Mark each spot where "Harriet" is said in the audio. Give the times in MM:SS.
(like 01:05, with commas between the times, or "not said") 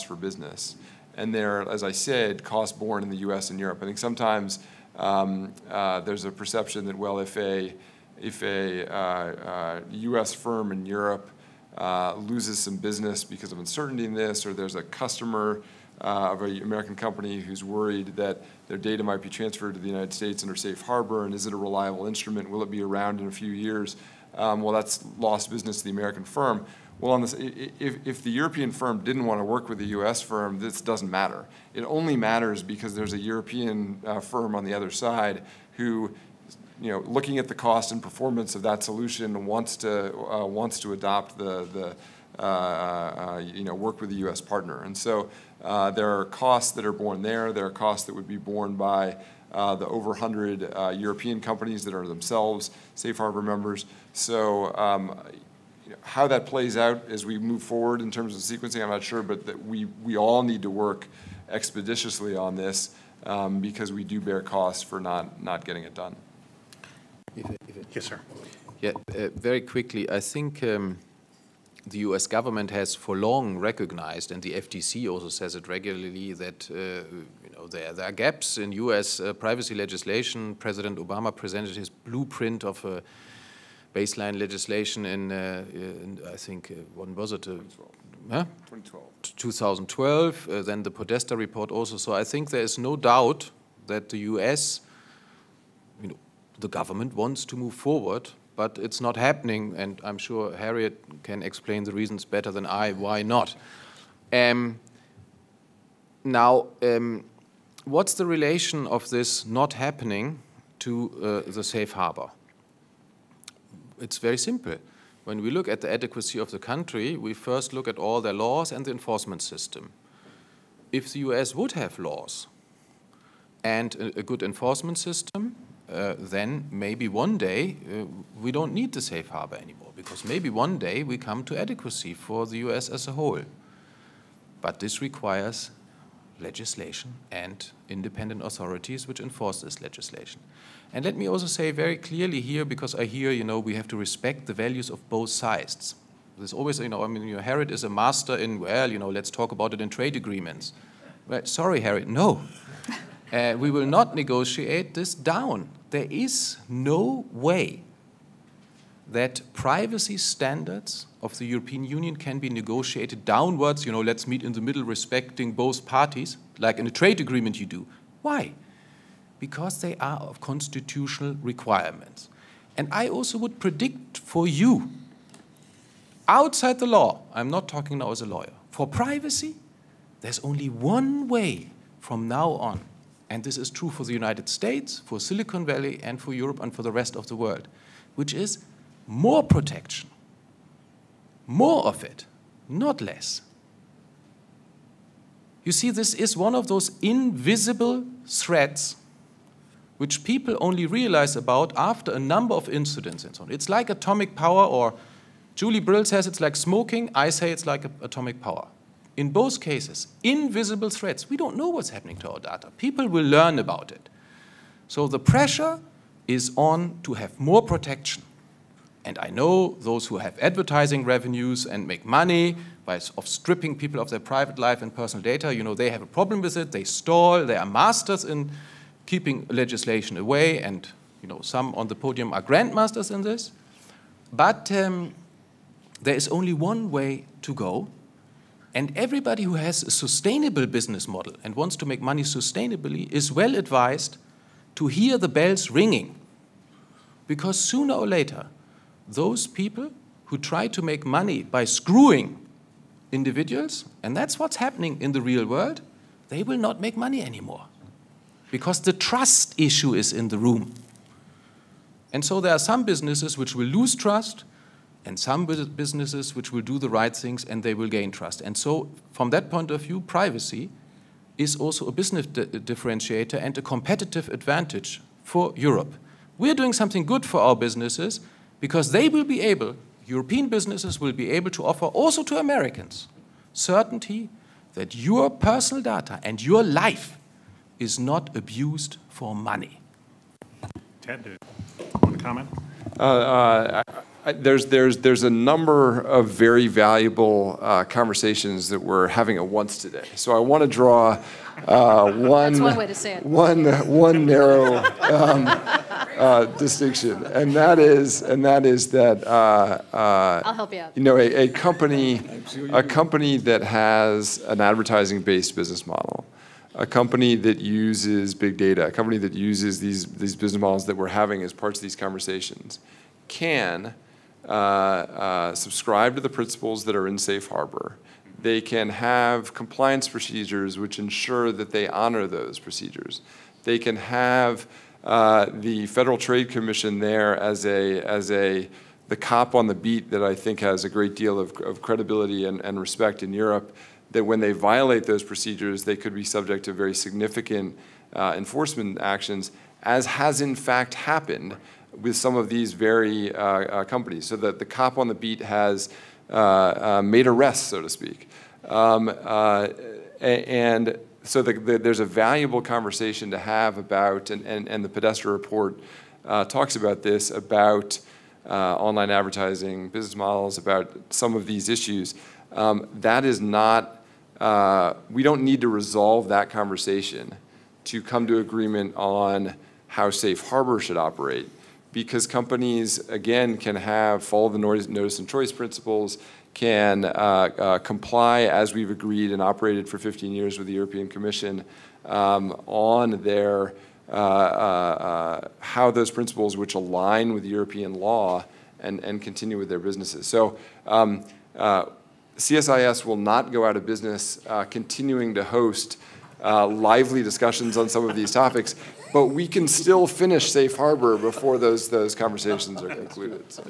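01:40, 02:27, 02:31.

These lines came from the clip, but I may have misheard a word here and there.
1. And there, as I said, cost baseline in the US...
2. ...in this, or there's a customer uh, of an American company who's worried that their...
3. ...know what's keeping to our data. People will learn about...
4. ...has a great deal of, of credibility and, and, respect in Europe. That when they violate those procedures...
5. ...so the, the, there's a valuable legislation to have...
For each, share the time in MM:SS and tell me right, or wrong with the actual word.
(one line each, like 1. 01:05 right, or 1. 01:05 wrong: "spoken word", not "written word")
1. 00:01 wrong: "borne", not "baseline"
2. 00:14 right
3. 03:31 wrong: "happening", not "keeping"
4. 05:40 right
5. 06:01 wrong: "conversation", not "legislation".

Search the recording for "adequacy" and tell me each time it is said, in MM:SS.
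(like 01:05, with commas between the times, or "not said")
01:55, 02:11.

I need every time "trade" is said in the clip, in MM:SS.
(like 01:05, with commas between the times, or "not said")
02:29, 02:46, 05:36.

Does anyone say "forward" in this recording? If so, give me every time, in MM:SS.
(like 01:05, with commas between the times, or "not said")
00:57, 01:37.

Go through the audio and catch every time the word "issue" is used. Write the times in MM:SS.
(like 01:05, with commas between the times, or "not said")
04:19, 06:11.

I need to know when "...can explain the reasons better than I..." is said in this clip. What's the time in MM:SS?
01:41.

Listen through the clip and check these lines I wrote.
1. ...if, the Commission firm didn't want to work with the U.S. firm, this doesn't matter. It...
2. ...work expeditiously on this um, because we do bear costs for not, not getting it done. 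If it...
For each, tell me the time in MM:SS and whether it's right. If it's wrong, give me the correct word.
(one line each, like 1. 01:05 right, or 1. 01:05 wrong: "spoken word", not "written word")
1. 00:28 wrong: "European", not "Commission"
2. 01:00 right.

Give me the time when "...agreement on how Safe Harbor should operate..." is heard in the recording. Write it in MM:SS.
06:18.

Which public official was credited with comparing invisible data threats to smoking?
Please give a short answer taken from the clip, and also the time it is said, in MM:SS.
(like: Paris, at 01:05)
Julie Brill, at 03:25.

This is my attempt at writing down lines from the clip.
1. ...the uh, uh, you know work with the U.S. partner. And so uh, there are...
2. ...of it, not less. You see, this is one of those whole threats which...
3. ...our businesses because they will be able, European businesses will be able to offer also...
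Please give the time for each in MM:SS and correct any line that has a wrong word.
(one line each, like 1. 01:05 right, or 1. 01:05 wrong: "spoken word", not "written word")
1. 00:41 right
2. 03:11 wrong: "invisible", not "whole"
3. 04:37 right.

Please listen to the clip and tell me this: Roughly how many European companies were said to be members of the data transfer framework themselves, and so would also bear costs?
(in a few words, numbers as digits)
over 100.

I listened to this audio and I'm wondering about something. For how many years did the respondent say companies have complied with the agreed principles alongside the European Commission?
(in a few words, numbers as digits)
15 years.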